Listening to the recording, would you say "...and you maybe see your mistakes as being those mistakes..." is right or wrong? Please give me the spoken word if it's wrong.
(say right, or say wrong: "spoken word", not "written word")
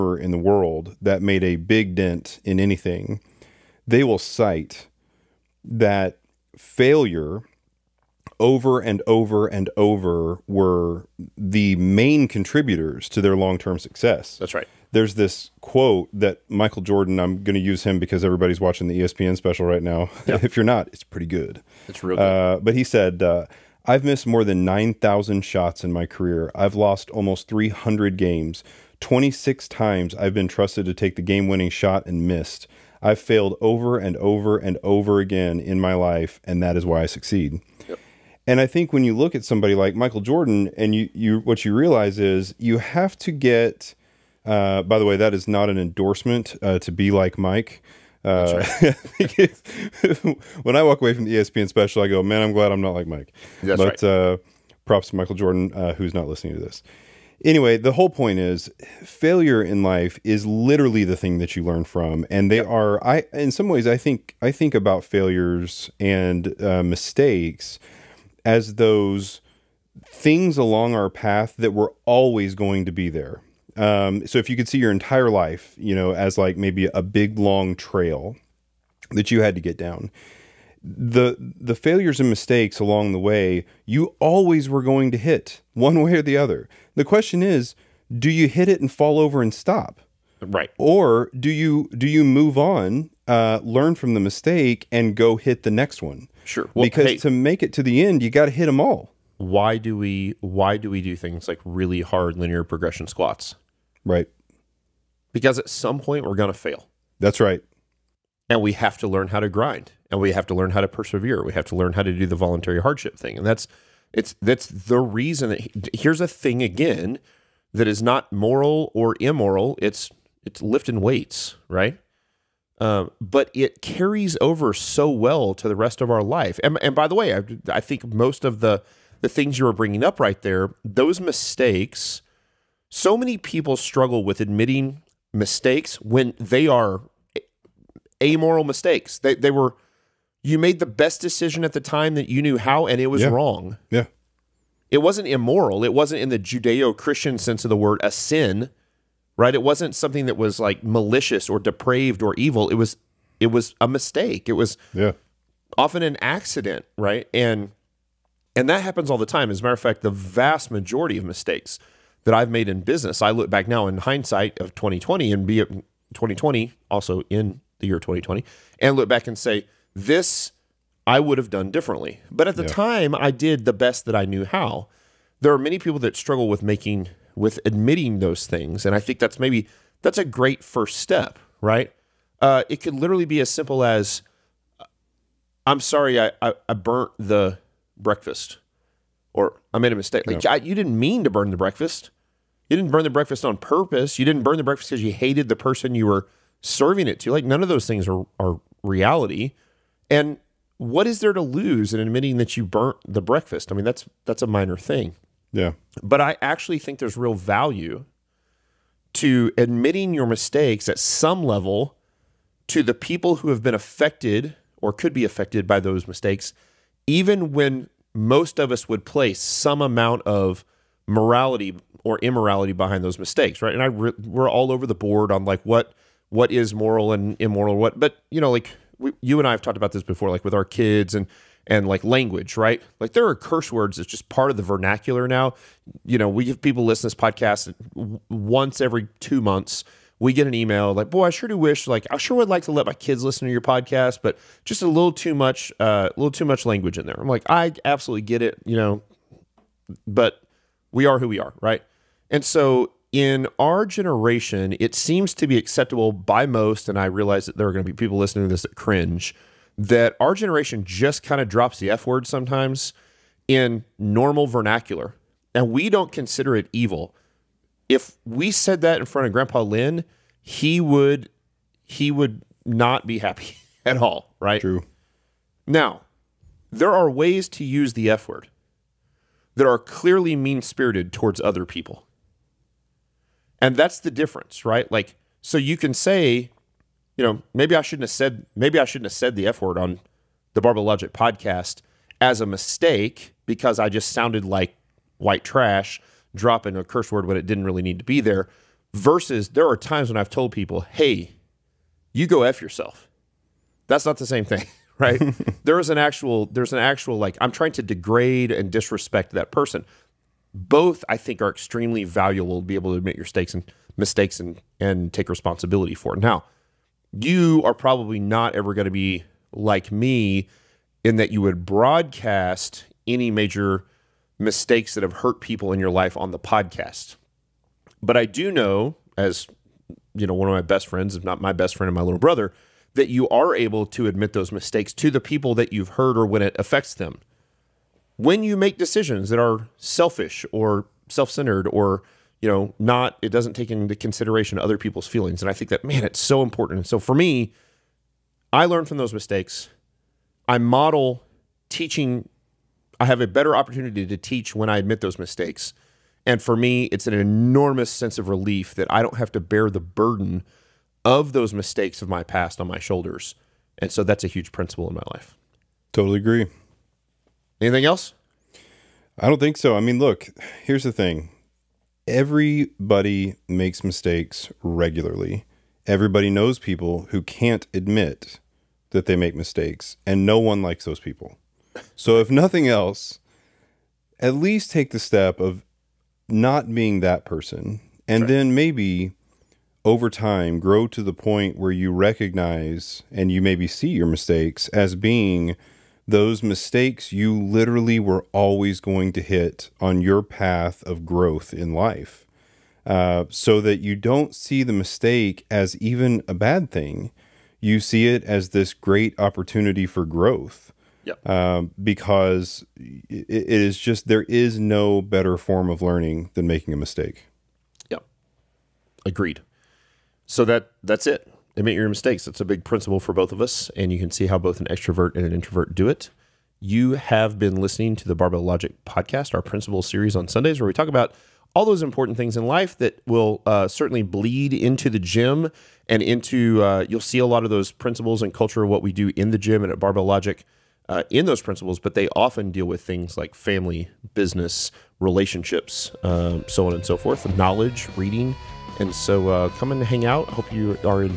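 right.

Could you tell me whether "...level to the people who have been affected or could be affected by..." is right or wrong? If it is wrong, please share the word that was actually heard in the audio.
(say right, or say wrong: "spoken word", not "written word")
right.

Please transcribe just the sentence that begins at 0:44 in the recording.
Uh, by the way, that is not an endorsement uh, to be like Mike.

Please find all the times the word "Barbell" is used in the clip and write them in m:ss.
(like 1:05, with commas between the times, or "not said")
4:50, 7:08, 7:19.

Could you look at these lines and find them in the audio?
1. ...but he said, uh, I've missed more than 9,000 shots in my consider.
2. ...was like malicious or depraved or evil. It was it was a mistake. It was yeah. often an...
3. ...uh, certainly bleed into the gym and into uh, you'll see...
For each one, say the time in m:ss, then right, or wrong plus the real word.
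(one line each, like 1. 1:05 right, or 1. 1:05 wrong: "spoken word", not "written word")
1. 0:22 wrong: "career", not "consider"
2. 2:30 right
3. 7:13 right.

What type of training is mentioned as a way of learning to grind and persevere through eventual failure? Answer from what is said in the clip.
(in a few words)
linear progression squats.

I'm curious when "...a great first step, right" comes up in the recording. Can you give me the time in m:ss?
3:00.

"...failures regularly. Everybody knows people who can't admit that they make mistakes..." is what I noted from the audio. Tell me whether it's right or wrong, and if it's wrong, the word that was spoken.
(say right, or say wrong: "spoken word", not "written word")
wrong: "mistakes", not "failures".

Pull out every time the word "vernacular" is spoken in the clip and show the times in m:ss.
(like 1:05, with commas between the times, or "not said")
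3:54, 4:24.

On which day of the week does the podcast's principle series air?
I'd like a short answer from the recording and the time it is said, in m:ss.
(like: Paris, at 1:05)
Sundays, at 7:10.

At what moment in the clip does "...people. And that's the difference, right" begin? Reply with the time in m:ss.
4:41.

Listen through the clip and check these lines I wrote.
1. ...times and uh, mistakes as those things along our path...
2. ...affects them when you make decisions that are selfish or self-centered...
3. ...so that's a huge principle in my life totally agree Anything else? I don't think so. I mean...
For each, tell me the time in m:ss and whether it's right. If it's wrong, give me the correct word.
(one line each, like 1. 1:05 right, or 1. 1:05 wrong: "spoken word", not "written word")
1. 1:05 wrong: "failures", not "times"
2. 5:36 right
3. 6:03 right.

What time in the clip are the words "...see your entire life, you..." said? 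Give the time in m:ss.
1:14.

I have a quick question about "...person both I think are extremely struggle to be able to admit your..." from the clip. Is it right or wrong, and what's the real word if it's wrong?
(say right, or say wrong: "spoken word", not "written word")
wrong: "valuable", not "struggle".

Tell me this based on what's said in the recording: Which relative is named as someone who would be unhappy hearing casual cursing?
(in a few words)
Grandpa Lynn.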